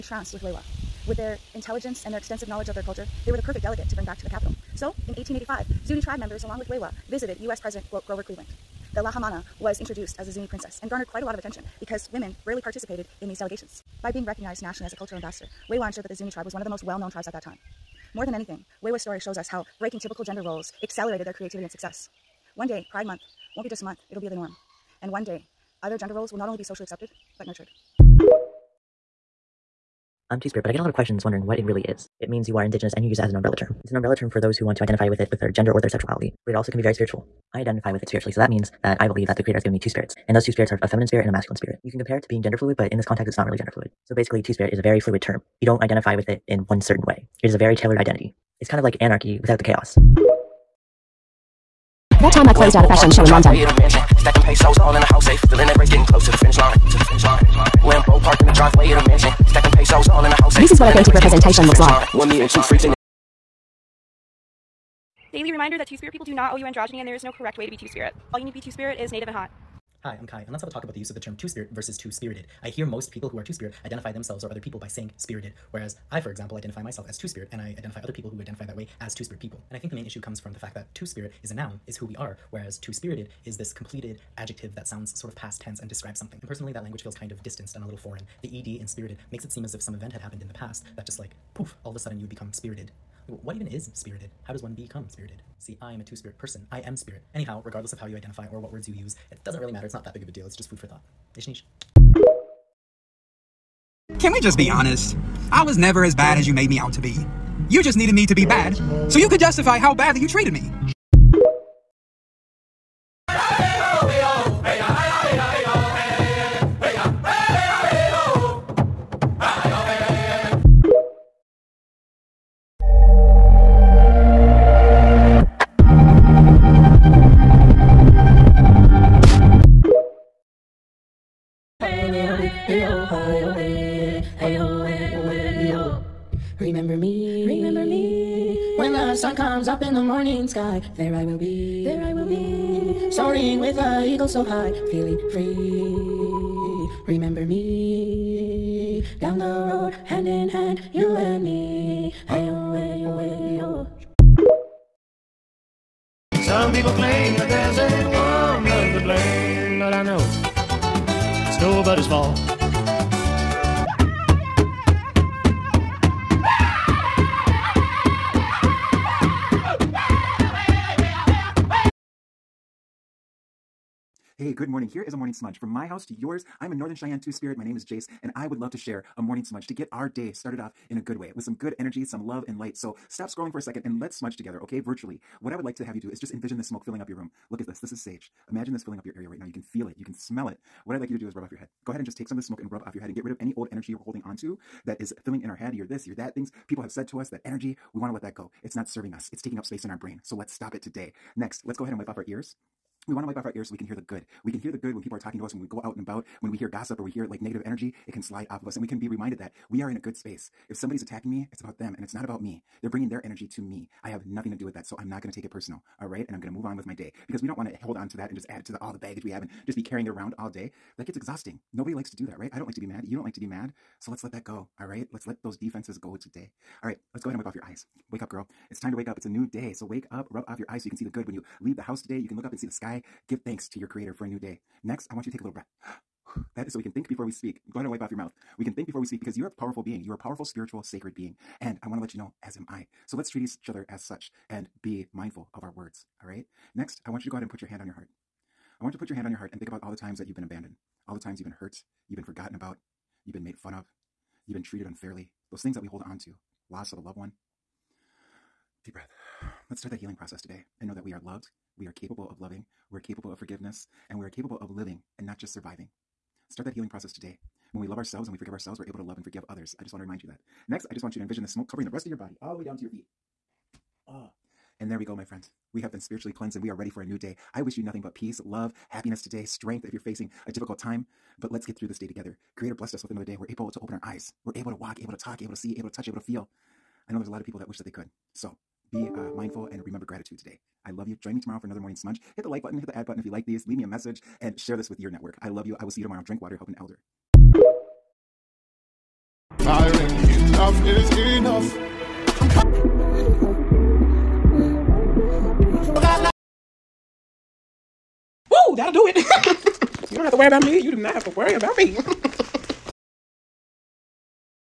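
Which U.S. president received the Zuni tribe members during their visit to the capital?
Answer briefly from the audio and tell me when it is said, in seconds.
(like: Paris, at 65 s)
Grover Cleveland, at 8 s.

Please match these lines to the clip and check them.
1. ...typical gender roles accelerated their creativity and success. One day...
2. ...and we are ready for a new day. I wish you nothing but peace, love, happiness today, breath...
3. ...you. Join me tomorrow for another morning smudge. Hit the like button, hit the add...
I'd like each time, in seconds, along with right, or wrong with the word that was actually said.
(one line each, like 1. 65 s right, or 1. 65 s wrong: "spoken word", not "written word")
1. 19 s right
2. 276 s wrong: "strength", not "breath"
3. 291 s right.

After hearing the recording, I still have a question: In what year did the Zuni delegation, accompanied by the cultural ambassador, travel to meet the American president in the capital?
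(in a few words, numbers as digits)
1885.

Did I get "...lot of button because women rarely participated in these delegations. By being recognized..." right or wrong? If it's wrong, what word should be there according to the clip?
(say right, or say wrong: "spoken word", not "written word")
wrong: "attention", not "button".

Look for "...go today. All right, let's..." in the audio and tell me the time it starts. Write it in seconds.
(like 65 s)
225 s.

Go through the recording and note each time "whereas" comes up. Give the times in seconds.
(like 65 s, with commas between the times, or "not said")
75 s, 82 s.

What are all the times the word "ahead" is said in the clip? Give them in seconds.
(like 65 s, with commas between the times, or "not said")
191 s, 201 s, 227 s, 237 s, 247 s.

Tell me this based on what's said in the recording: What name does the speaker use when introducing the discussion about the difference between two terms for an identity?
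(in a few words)
Kai.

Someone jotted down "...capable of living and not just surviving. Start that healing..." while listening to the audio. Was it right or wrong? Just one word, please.
right.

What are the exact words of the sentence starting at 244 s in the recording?
And be mindful of our words.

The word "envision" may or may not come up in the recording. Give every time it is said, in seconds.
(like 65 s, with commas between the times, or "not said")
186 s, 271 s.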